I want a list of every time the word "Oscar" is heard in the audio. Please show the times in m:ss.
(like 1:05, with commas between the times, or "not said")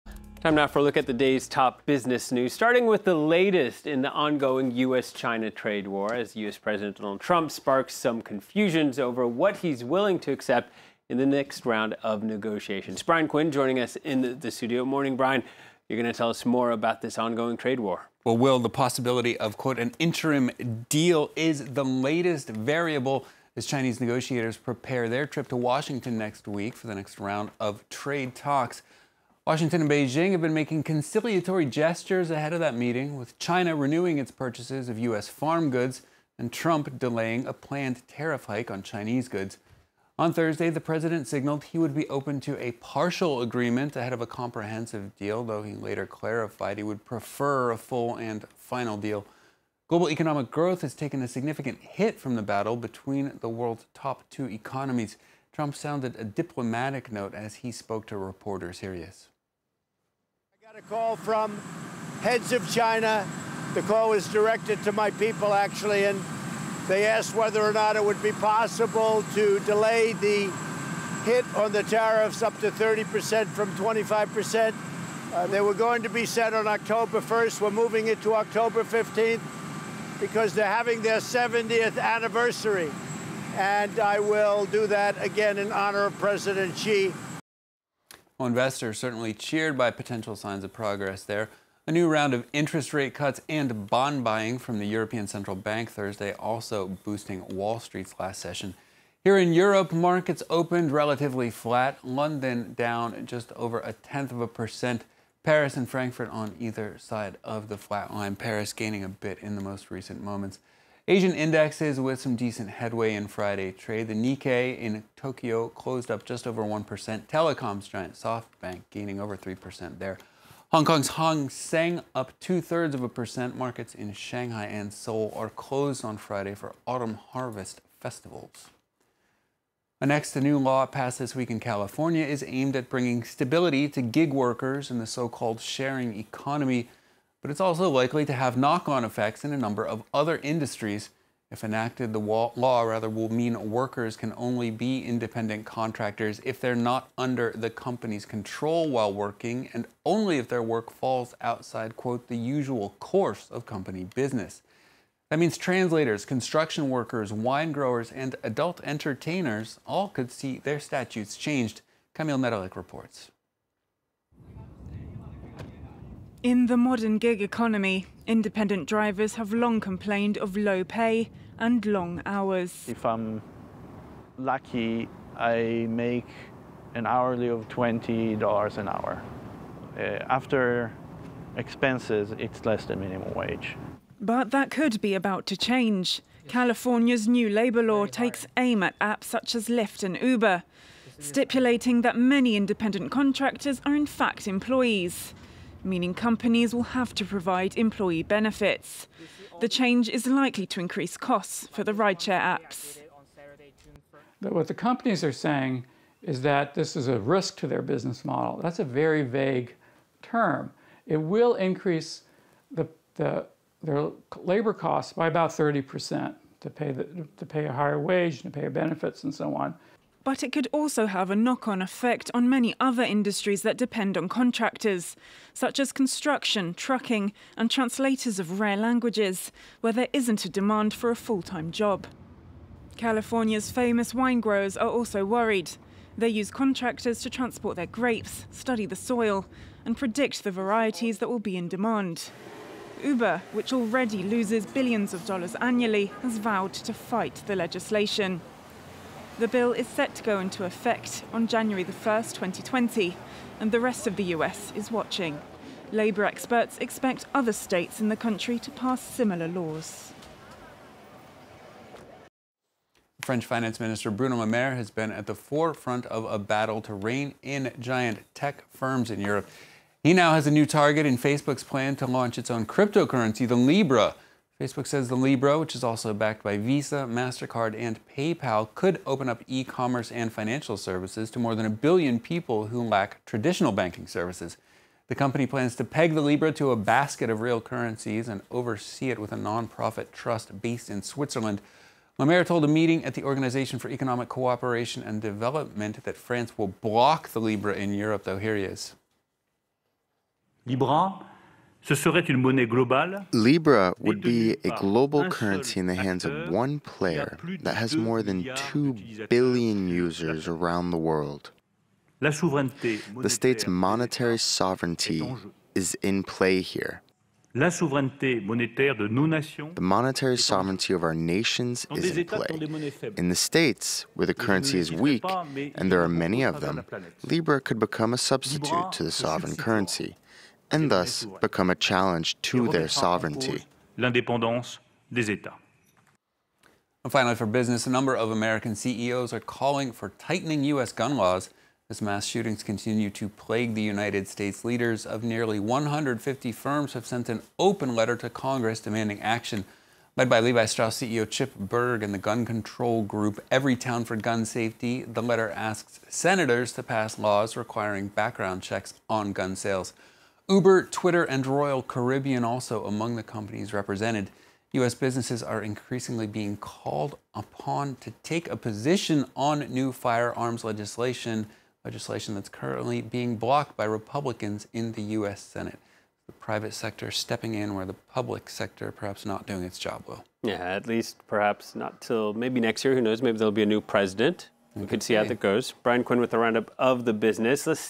not said.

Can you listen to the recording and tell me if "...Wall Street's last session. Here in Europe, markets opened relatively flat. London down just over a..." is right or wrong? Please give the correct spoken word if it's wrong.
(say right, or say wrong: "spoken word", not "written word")
right.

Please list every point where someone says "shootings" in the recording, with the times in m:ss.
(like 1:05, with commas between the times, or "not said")
5:42.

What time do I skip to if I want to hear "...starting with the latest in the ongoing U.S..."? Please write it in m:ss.
0:02.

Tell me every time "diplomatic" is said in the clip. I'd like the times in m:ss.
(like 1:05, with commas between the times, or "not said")
0:56.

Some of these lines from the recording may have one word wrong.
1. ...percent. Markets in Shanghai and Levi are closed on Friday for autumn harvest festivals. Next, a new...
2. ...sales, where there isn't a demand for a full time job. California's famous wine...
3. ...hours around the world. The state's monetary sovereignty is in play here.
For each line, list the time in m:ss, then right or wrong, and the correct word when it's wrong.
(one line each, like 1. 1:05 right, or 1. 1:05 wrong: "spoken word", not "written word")
1. 2:03 wrong: "Seoul", not "Levi"
2. 3:48 wrong: "languages", not "sales"
3. 5:09 wrong: "users", not "hours".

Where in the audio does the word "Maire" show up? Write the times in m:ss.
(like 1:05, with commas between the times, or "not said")
4:24, 4:52.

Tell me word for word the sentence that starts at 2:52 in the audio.
If I'm lucky, I make an hourly of $20 an hour.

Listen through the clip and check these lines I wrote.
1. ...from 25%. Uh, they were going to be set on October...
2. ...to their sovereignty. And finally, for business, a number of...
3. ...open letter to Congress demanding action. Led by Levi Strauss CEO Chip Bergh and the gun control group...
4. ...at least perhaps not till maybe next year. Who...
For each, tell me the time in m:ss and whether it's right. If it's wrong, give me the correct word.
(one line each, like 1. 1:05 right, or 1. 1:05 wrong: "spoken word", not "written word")
1. 1:13 right
2. 5:32 right
3. 5:47 right
4. 6:20 right.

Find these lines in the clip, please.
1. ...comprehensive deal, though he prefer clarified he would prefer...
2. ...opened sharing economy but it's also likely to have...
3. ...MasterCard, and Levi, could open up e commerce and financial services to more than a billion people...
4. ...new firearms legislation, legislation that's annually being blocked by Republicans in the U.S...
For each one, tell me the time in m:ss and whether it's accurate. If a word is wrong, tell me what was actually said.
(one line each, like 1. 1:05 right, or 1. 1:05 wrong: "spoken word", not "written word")
1. 0:44 wrong: "later", not "prefer"
2. 2:15 wrong: "called", not "opened"
3. 4:37 wrong: "PayPal", not "Levi"
4. 6:09 wrong: "currently", not "annually".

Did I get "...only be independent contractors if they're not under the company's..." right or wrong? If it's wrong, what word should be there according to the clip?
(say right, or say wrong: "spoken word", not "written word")
right.